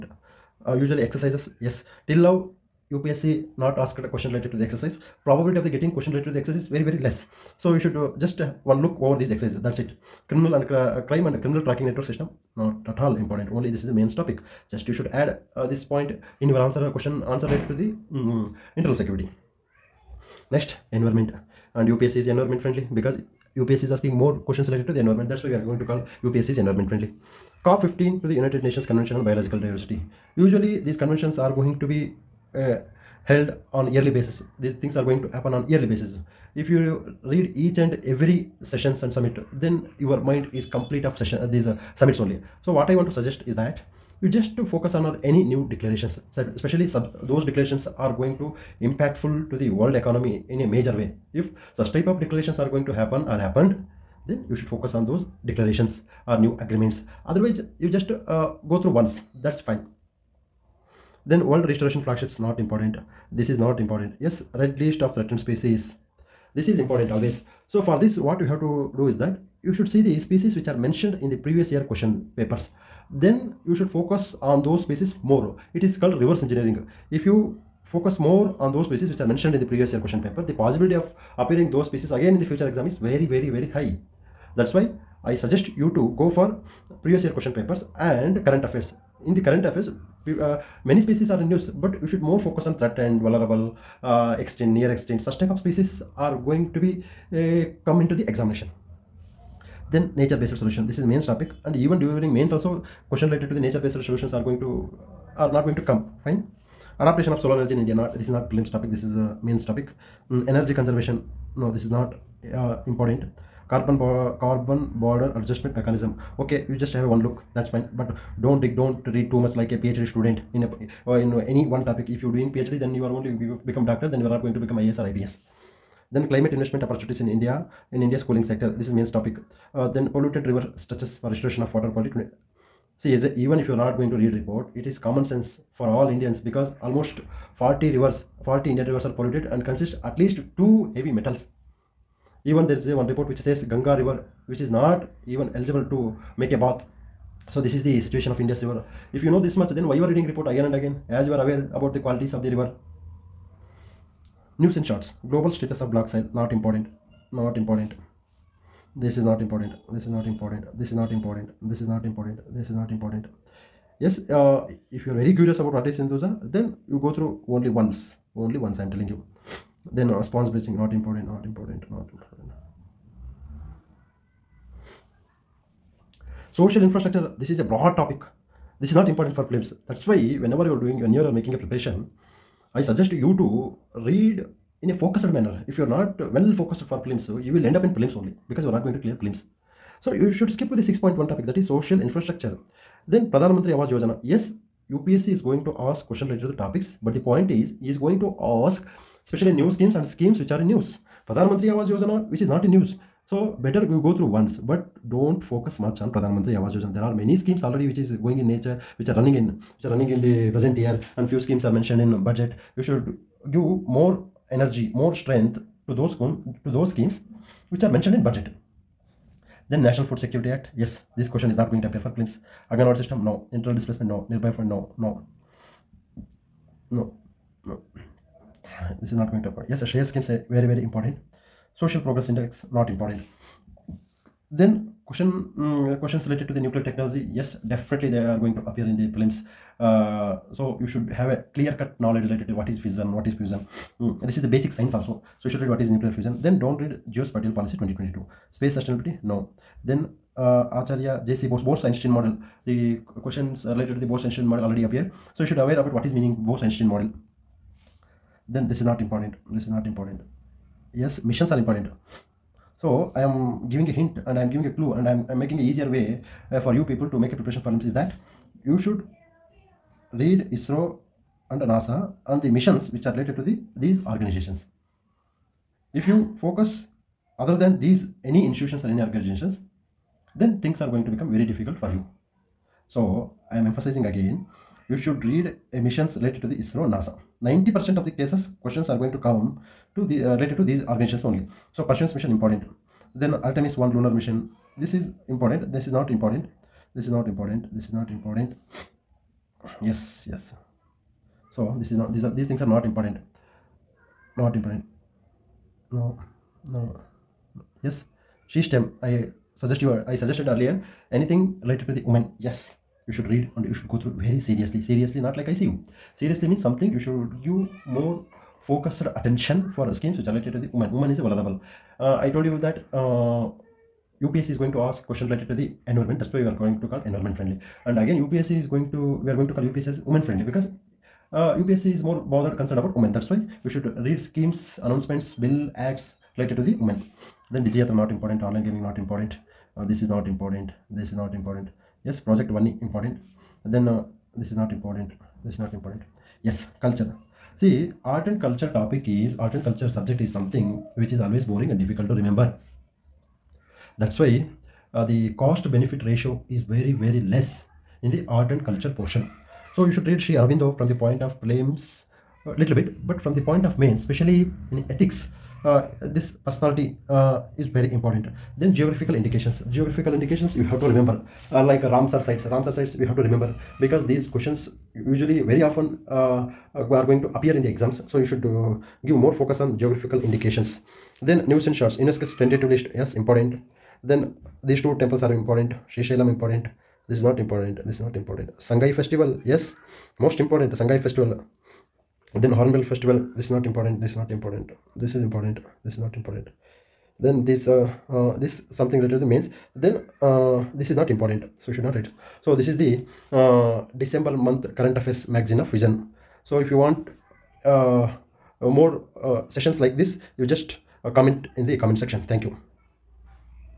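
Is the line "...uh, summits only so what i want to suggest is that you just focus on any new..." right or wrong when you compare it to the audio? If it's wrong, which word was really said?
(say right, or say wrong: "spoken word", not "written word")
right.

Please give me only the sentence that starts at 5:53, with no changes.
That's why uh, the cost benefit ratio is very very less in the art and culture portion.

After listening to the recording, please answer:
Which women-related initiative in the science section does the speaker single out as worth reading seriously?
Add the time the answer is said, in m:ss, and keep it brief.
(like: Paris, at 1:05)
SheSTEM, at 5:08.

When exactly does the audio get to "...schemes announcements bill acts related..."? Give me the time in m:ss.
5:34.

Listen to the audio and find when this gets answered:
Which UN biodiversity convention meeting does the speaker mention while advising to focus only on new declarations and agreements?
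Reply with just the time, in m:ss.
0:27.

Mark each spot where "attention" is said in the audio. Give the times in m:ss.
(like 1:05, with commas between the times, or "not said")
5:19.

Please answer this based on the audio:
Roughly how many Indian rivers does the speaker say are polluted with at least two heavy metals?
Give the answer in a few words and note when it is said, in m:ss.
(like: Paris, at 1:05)
40, at 2:18.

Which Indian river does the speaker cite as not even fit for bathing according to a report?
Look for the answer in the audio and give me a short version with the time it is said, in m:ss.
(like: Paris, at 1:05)
Ganga, at 2:23.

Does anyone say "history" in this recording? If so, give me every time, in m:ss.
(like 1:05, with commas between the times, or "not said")
not said.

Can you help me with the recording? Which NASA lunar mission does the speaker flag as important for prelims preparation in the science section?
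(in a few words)
Artemis 1.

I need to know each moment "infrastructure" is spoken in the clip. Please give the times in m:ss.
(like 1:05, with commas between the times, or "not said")
2:56, 3:12.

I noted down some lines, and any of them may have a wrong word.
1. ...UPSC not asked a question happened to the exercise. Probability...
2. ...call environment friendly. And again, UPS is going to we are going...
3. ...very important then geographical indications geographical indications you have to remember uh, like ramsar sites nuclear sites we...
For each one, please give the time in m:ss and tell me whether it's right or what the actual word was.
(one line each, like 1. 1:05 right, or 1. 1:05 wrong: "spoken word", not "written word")
1. 0:02 wrong: "related", not "happened"
2. 5:26 right
3. 6:07 wrong: "ramsar", not "nuclear".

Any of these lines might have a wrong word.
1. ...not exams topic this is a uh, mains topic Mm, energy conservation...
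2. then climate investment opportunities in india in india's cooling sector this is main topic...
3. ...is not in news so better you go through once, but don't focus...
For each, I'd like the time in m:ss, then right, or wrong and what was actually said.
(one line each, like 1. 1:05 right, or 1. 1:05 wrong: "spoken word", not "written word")
1. 1:48 wrong: "prelims", not "exams"
2. 2:06 right
3. 3:22 right.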